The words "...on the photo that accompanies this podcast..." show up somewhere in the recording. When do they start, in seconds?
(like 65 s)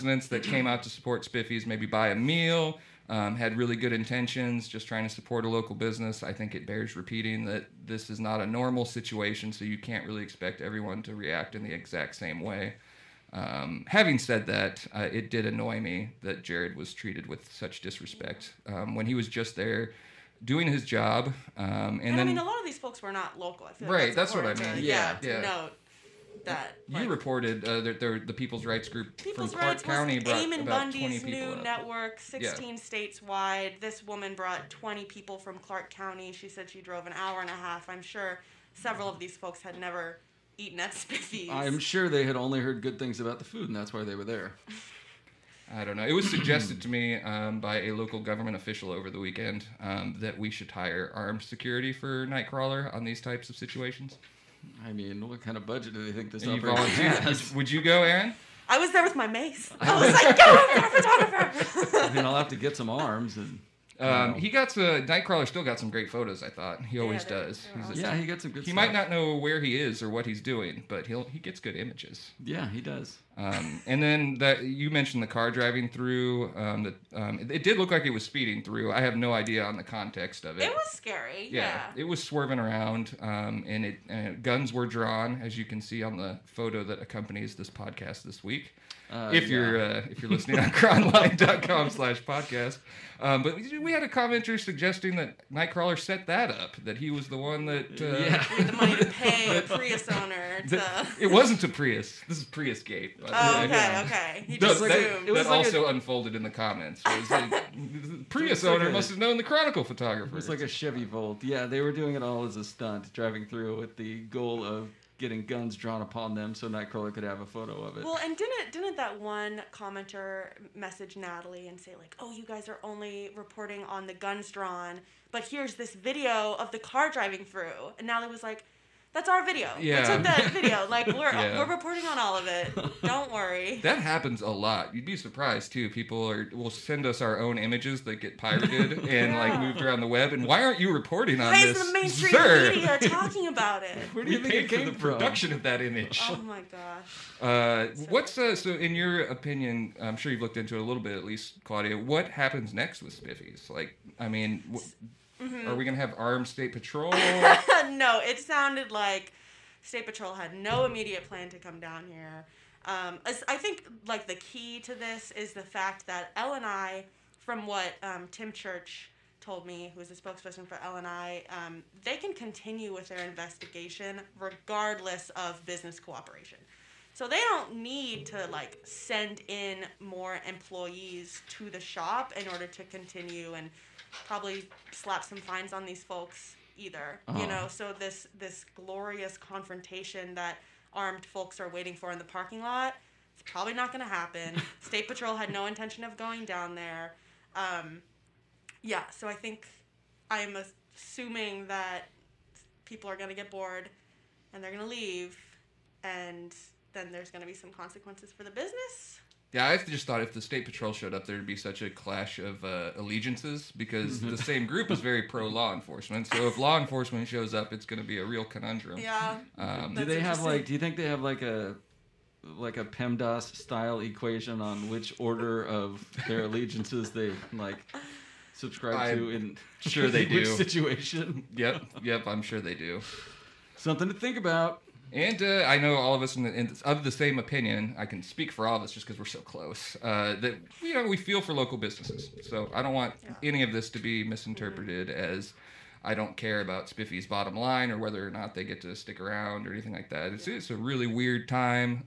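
86 s.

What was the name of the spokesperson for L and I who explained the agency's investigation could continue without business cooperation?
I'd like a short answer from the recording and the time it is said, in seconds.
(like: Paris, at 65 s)
Tim Church, at 168 s.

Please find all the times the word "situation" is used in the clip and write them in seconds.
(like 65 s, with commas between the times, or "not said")
8 s, 53 s, 230 s.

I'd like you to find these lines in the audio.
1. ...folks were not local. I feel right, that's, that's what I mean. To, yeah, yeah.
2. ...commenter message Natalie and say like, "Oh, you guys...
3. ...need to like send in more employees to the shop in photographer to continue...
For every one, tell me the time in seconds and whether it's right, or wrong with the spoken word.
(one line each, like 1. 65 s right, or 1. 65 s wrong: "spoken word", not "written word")
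1. 22 s right
2. 119 s right
3. 177 s wrong: "order", not "photographer".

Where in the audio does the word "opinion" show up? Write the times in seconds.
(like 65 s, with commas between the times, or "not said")
149 s, 237 s.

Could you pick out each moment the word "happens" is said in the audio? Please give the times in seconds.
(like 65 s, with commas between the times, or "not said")
133 s, 152 s, 194 s.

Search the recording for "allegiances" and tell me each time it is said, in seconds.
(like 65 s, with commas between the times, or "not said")
212 s, 226 s.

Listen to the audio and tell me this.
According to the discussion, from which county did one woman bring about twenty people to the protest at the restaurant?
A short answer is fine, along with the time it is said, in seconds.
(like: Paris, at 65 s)
Clark County, at 35 s.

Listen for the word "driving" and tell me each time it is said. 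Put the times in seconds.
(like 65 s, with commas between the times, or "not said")
75 s, 113 s, 127 s.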